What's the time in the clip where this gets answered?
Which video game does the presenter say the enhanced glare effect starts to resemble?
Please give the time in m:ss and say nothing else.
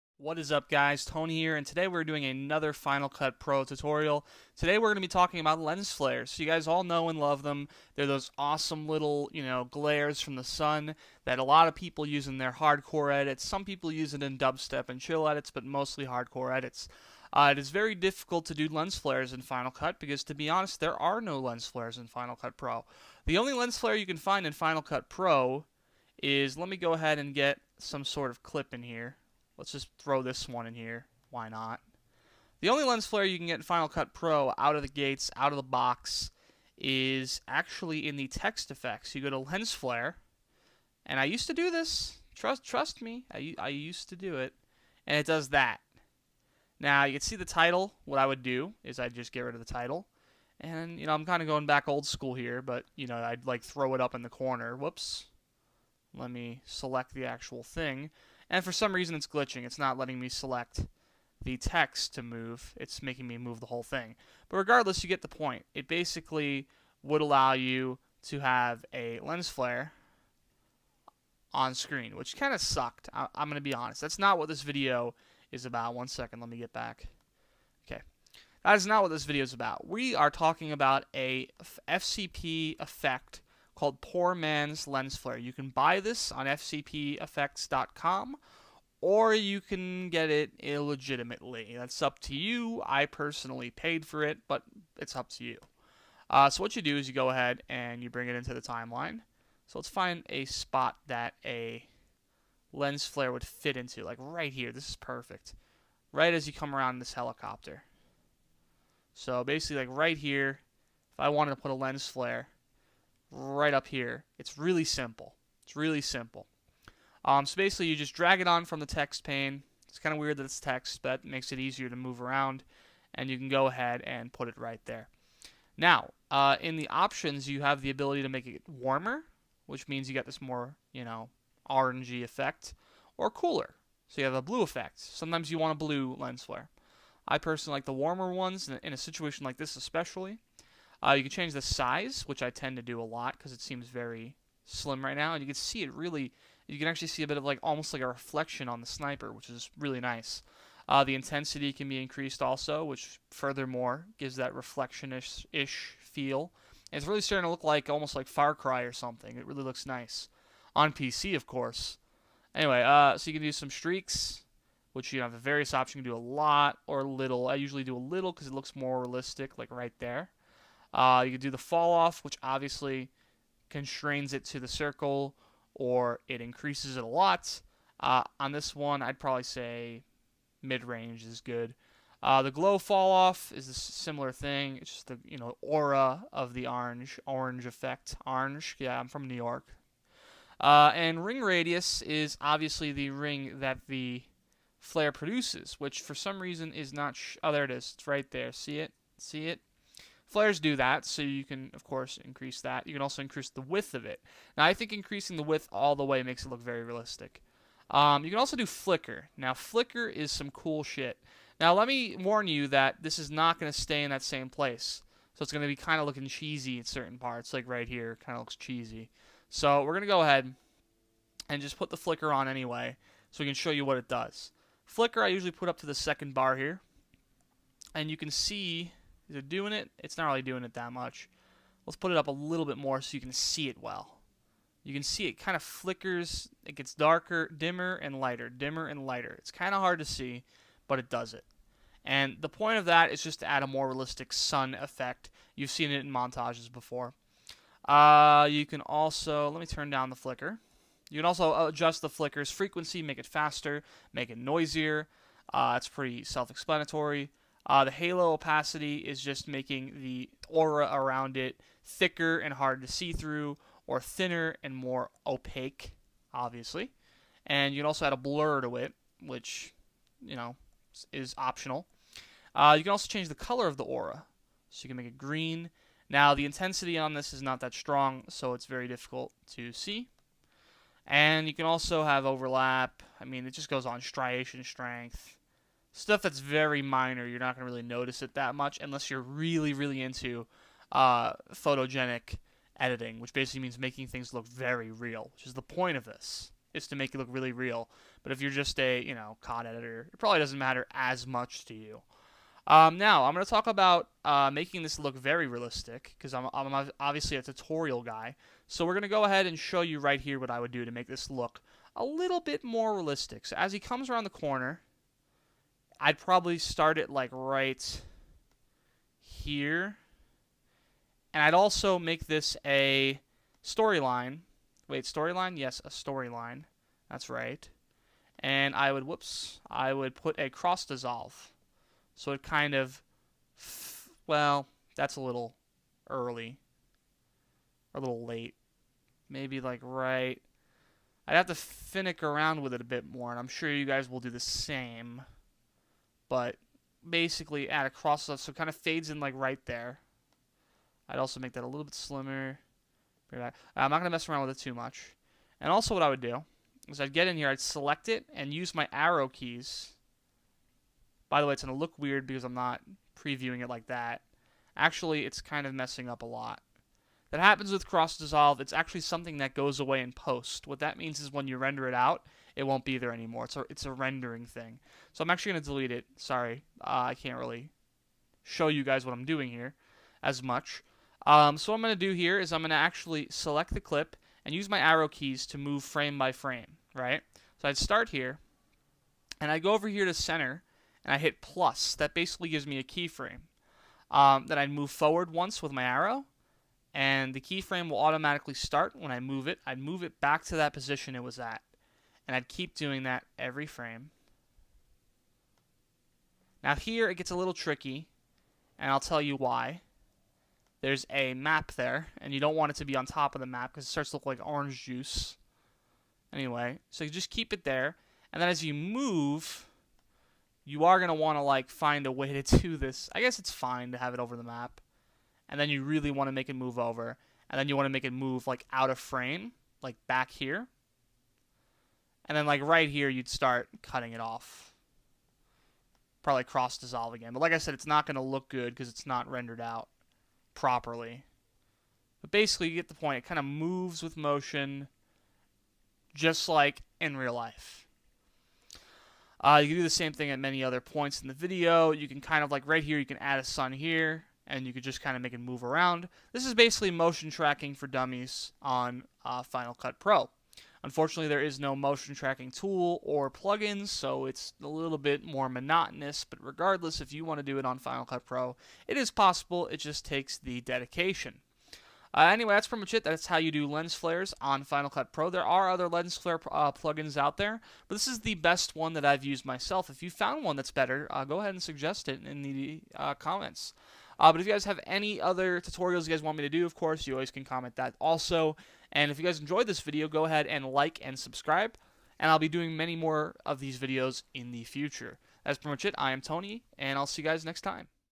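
2:38.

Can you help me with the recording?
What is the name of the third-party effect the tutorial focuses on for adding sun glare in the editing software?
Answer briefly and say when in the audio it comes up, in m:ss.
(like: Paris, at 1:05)
Poor Man's Lens Flare, at 1:24.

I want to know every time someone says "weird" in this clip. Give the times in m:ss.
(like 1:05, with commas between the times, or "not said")
2:00, 6:01.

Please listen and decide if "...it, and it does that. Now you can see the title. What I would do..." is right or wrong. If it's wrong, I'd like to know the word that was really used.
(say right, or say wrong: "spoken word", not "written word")
right.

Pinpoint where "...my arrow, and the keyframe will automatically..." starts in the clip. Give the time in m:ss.
6:35.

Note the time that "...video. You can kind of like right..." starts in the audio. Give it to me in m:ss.
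7:31.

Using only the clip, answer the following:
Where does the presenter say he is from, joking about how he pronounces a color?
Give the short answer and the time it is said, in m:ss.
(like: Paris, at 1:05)
New York, at 3:09.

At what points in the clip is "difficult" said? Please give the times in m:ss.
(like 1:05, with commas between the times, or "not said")
0:17, 4:38.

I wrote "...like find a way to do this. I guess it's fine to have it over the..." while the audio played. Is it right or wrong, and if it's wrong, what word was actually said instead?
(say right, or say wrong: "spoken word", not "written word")
right.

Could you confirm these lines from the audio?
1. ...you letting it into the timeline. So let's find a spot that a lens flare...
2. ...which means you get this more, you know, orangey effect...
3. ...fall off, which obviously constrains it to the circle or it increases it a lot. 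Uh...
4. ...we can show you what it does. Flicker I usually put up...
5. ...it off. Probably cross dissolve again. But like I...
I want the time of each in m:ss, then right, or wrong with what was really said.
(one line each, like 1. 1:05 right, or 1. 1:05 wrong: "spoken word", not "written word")
1. 1:38 wrong: "bring", not "letting"
2. 2:09 right
3. 2:51 right
4. 3:43 right
5. 7:14 right.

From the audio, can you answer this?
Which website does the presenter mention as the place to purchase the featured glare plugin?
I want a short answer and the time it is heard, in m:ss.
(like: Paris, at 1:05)
fcpeffects.com, at 1:26.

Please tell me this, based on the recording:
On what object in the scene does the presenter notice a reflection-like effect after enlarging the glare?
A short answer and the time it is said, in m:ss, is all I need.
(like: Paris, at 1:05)
the sniper, at 2:28.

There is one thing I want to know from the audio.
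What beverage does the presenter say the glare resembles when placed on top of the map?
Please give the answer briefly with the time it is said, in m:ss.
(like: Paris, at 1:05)
orange juice, at 6:54.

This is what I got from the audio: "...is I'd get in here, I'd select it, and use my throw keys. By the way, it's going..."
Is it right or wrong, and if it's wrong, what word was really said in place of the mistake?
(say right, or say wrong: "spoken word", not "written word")
wrong: "arrow", not "throw".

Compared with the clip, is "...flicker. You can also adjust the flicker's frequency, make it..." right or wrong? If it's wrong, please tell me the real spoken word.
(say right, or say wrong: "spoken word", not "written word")
right.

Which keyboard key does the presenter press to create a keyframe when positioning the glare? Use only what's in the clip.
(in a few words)
plus.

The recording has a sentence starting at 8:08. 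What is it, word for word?
And if you guys enjoyed this video, go ahead and like and subscribe.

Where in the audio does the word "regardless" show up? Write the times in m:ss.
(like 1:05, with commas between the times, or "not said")
1:04, 7:46.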